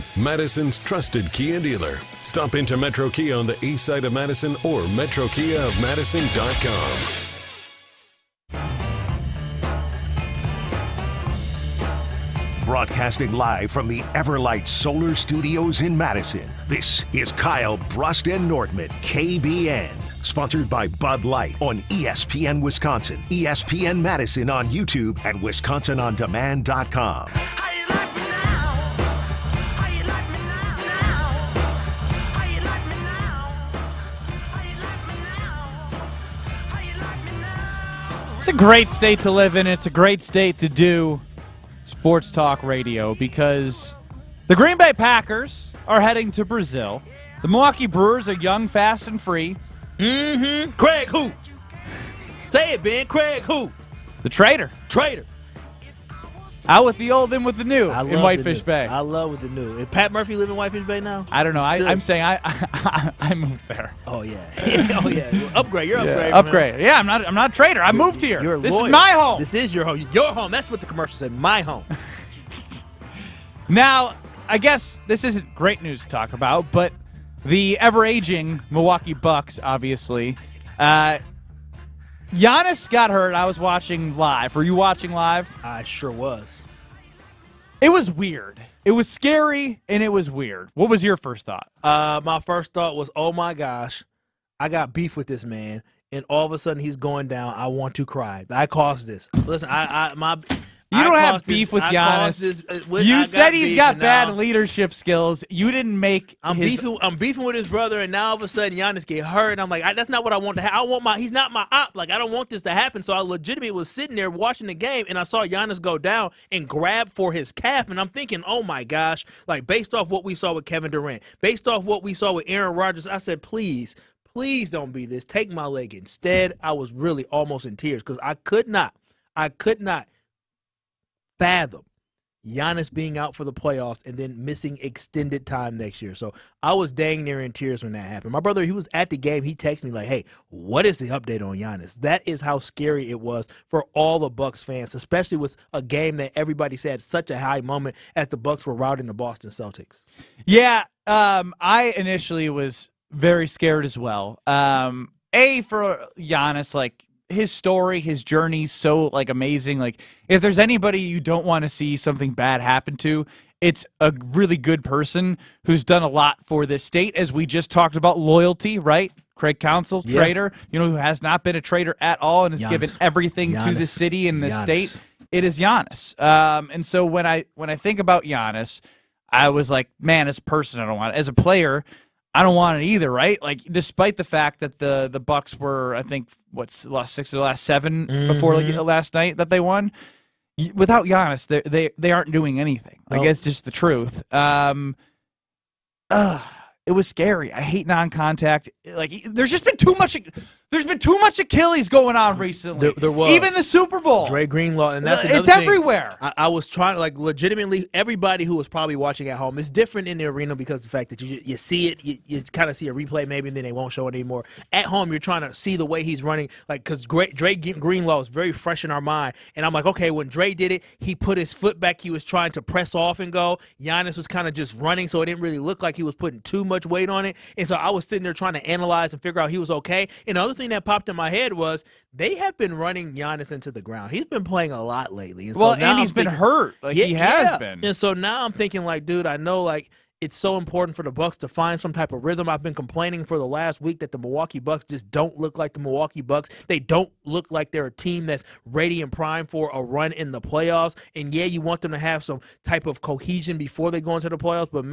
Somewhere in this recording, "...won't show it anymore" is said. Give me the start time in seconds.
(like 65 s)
213 s.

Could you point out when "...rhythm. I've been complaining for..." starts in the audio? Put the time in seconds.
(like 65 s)
242 s.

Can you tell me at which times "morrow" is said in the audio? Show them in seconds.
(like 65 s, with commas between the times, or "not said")
not said.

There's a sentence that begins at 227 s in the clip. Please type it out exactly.
And so I was sitting there trying to analyze and figure out he was okay.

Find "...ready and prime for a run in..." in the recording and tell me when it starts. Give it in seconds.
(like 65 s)
248 s.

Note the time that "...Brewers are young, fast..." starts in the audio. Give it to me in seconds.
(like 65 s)
47 s.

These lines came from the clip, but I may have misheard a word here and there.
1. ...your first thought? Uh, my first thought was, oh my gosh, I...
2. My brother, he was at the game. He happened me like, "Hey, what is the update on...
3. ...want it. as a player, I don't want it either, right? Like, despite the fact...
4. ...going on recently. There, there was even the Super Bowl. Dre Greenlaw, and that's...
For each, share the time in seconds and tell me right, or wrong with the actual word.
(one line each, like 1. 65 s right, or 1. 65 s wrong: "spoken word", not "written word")
1. 91 s right
2. 138 s wrong: "texted", not "happened"
3. 180 s right
4. 201 s right.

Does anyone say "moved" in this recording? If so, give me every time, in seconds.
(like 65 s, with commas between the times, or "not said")
63 s, 68 s.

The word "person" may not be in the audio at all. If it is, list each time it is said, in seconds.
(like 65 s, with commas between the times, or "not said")
164 s, 180 s.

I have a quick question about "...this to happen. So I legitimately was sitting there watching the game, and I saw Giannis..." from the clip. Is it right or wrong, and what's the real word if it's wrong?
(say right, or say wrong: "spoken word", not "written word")
right.